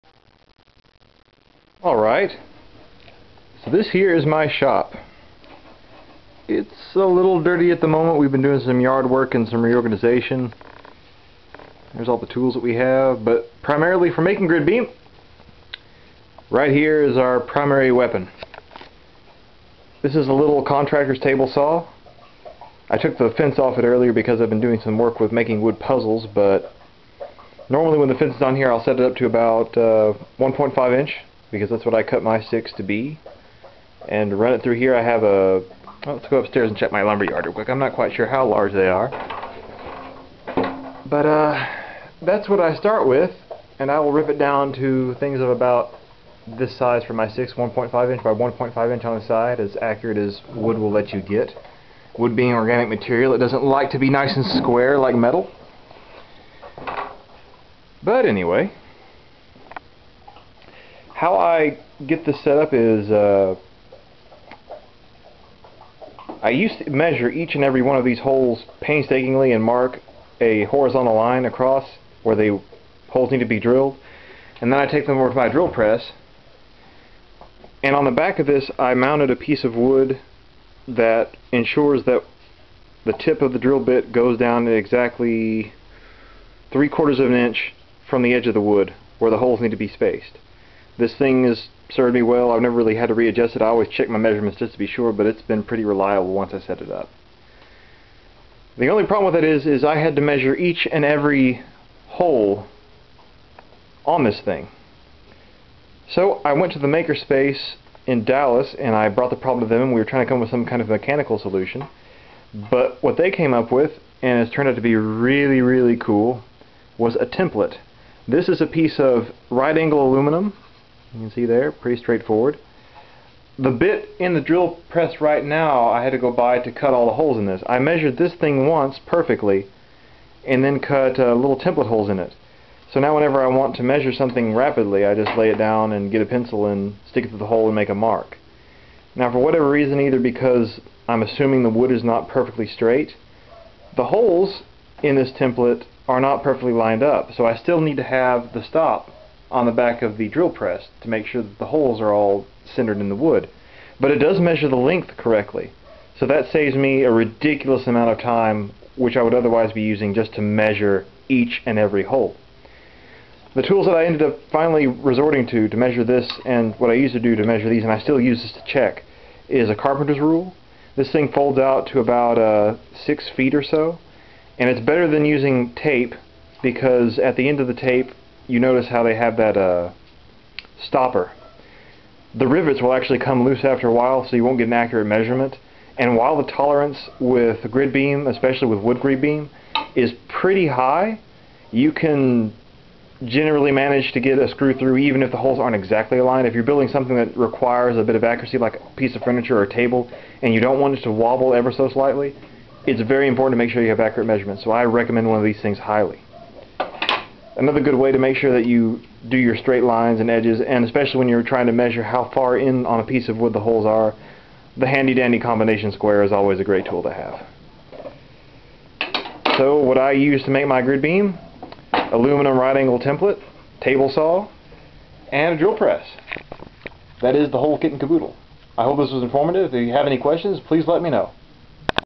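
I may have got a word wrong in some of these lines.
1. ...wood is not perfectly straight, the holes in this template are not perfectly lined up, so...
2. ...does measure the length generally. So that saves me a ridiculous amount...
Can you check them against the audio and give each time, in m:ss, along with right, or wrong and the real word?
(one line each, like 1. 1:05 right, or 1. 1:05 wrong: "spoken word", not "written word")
1. 2:21 right
2. 2:34 wrong: "correctly", not "generally".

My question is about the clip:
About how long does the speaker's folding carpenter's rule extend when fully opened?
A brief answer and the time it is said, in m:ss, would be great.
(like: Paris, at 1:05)
6 feet, at 2:52.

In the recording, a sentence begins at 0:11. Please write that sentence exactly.
There's all the tools that we have, but primarily for making grid beam, right here is our primary weapon.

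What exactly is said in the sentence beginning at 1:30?
This thing has served me well.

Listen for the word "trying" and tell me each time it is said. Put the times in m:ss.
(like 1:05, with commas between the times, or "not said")
1:50, 3:31.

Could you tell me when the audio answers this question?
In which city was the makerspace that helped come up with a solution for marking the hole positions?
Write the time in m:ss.
1:48.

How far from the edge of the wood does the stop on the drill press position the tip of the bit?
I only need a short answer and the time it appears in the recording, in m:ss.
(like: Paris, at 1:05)
3/4 of an inch, at 1:26.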